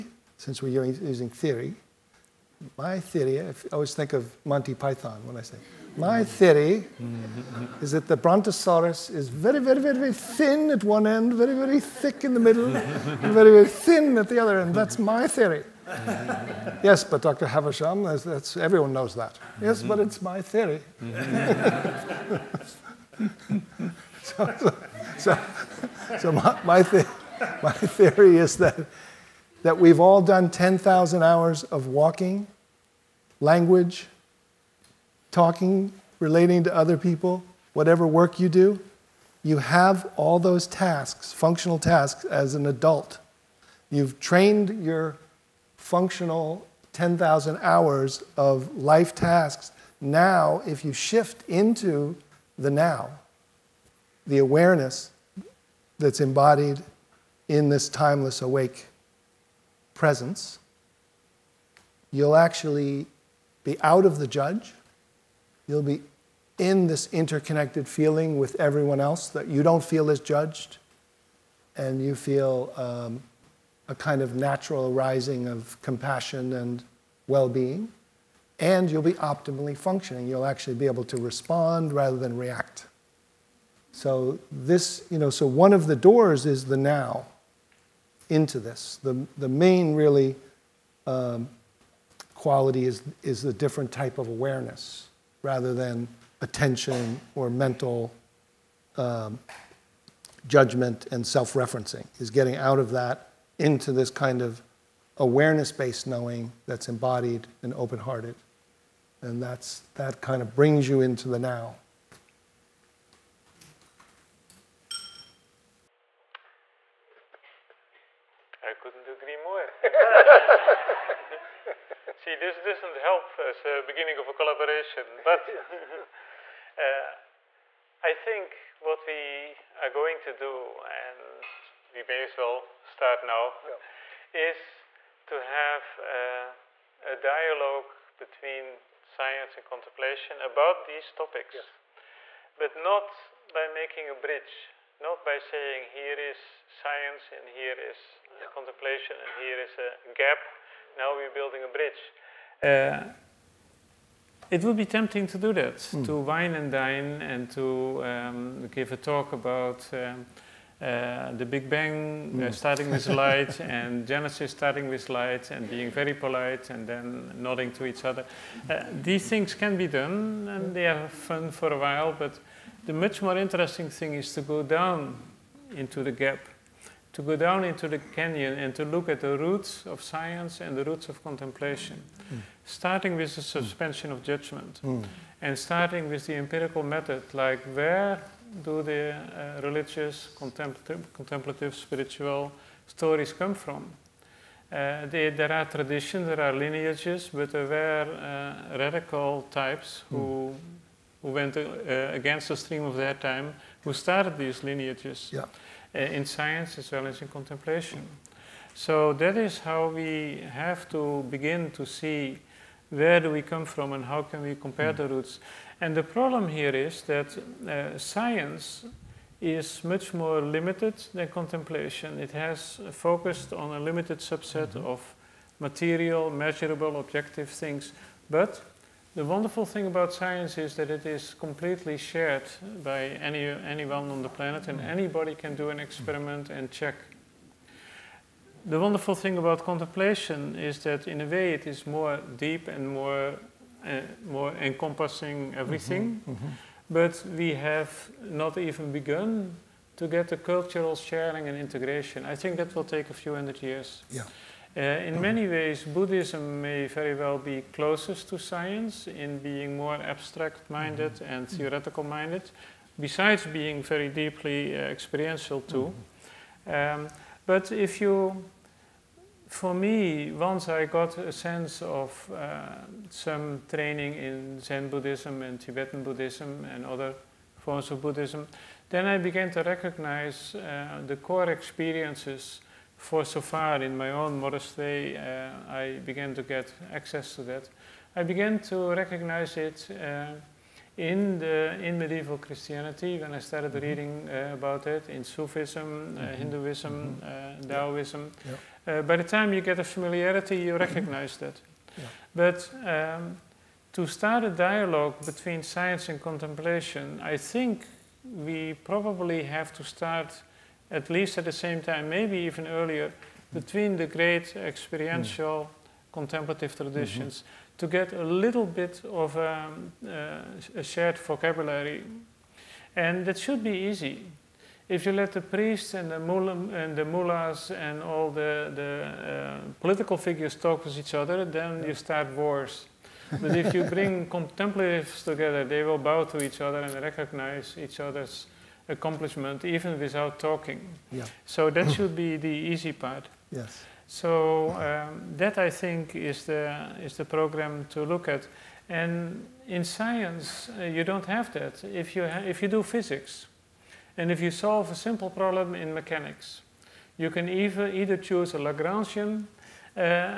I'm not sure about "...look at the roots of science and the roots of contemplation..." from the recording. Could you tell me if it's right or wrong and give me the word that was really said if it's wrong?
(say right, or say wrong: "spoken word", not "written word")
right.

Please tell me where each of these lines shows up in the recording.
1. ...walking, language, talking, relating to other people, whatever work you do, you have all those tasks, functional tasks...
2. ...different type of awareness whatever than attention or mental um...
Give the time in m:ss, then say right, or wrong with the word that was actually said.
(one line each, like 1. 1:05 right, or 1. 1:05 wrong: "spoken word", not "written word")
1. 0:31 right
2. 1:33 wrong: "rather", not "whatever".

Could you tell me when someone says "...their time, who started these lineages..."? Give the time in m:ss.
3:22.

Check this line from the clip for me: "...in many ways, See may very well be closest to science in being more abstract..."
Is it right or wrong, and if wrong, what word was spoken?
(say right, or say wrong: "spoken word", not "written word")
wrong: "Buddhism", not "See".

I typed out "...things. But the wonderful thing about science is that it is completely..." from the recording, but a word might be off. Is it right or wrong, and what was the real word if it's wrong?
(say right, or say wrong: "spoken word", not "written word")
right.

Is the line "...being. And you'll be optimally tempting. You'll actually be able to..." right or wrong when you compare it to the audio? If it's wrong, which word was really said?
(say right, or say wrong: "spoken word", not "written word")
wrong: "functioning", not "tempting".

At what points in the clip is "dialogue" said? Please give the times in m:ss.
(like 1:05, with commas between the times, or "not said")
2:17, 5:04.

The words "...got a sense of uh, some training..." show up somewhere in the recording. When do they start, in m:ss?
4:30.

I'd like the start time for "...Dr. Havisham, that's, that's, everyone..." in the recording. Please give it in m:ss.
0:17.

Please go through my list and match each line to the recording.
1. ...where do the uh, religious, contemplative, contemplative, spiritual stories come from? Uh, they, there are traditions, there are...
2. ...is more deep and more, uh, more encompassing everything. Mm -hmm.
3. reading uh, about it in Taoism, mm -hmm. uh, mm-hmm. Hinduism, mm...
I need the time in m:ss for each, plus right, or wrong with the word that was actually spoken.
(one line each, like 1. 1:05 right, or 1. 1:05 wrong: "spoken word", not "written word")
1. 3:07 right
2. 4:01 right
3. 4:53 wrong: "Sufism", not "Taoism".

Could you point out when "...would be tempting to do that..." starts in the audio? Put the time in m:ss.
2:34.